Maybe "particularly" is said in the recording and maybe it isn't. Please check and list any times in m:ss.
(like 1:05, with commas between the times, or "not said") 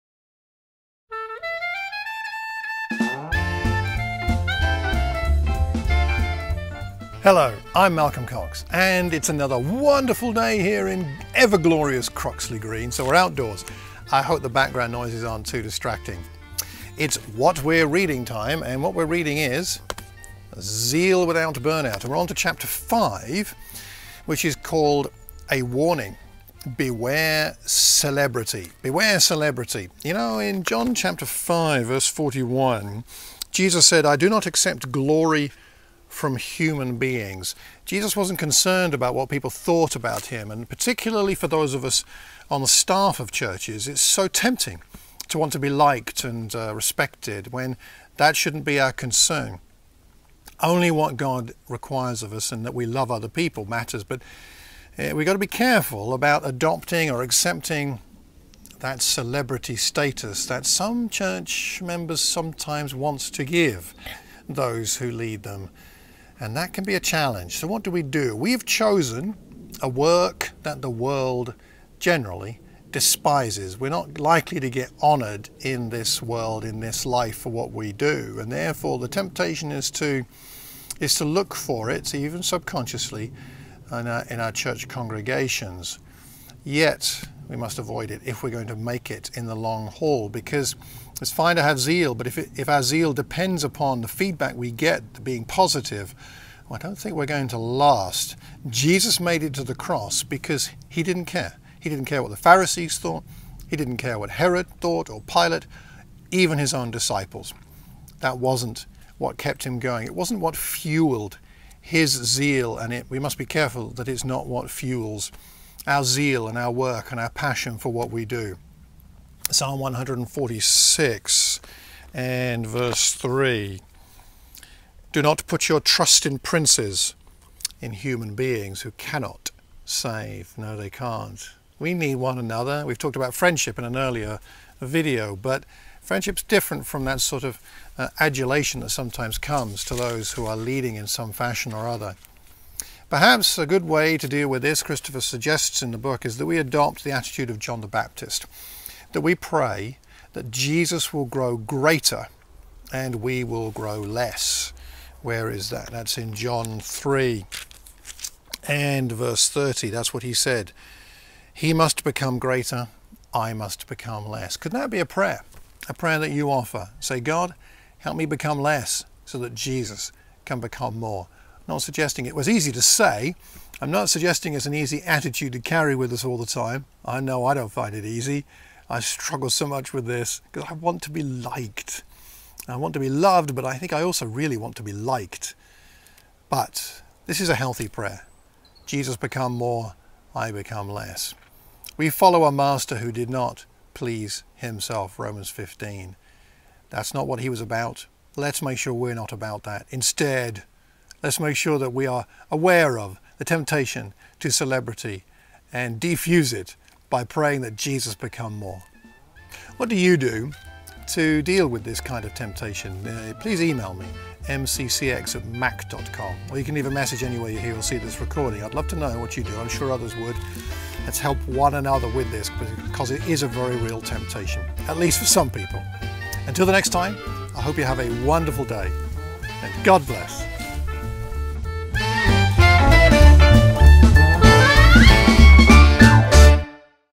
0:40.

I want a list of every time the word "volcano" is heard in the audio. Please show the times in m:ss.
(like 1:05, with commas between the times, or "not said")
not said.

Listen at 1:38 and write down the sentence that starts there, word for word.
Jesus made it to the cross because he didn't care.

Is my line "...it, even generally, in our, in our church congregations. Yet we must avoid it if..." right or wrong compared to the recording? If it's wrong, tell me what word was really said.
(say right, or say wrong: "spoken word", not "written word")
wrong: "subconsciously", not "generally".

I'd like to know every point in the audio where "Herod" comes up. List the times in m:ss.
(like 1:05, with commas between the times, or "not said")
1:44.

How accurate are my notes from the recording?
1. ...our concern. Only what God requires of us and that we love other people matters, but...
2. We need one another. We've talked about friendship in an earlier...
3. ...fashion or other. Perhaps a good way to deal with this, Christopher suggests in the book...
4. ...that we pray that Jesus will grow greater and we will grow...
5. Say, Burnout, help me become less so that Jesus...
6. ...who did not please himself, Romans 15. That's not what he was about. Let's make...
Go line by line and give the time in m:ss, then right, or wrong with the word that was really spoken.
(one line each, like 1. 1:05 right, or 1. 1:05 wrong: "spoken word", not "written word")
1. 0:48 right
2. 2:11 right
3. 2:21 right
4. 2:29 right
5. 2:47 wrong: "God", not "Burnout"
6. 3:12 right.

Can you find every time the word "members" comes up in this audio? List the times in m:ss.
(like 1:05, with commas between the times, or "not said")
1:01.